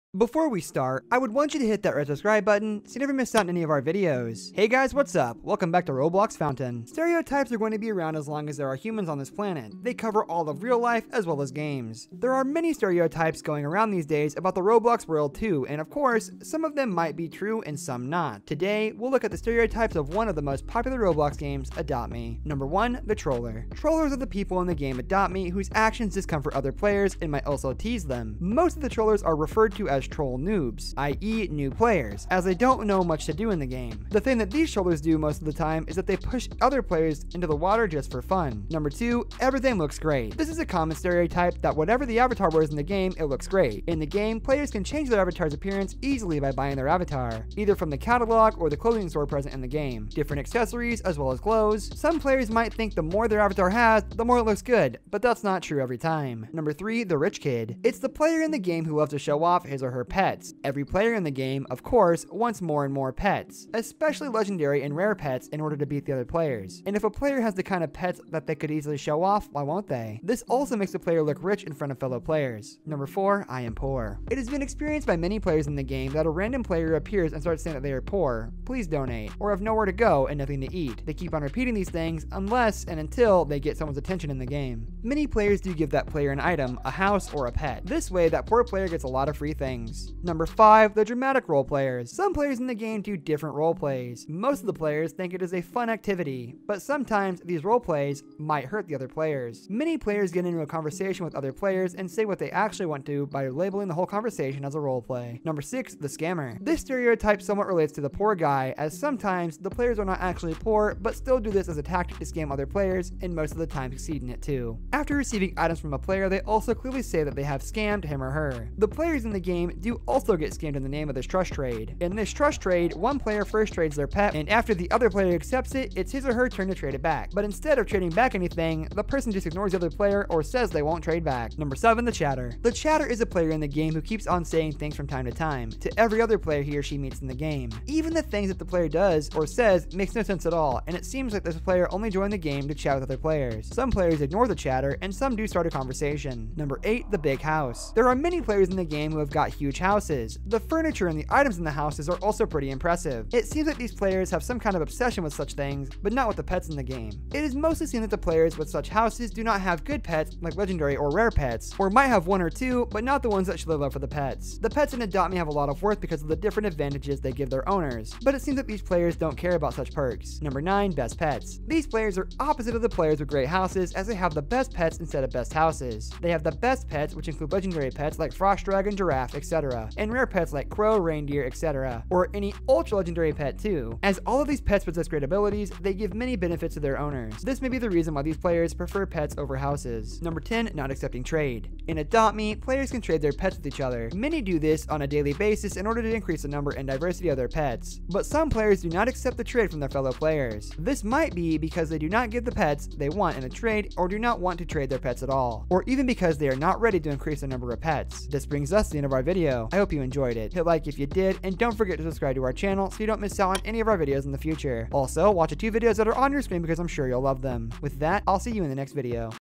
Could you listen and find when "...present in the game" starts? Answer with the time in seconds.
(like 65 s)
49 s.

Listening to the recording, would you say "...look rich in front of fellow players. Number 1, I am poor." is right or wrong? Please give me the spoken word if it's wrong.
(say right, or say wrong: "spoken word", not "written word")
wrong: "4", not "1".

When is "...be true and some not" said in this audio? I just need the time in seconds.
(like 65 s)
17 s.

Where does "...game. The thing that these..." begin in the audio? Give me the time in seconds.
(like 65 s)
33 s.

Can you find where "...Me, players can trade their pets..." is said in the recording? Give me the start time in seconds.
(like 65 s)
192 s.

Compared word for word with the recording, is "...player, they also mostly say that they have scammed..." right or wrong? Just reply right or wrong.
wrong.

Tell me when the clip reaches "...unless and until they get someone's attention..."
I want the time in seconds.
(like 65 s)
82 s.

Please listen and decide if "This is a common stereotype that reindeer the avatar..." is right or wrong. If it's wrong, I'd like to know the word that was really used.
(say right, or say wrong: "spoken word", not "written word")
wrong: "whatever", not "reindeer".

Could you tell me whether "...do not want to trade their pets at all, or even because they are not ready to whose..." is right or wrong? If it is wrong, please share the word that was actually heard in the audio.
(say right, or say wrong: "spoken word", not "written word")
wrong: "increase", not "whose".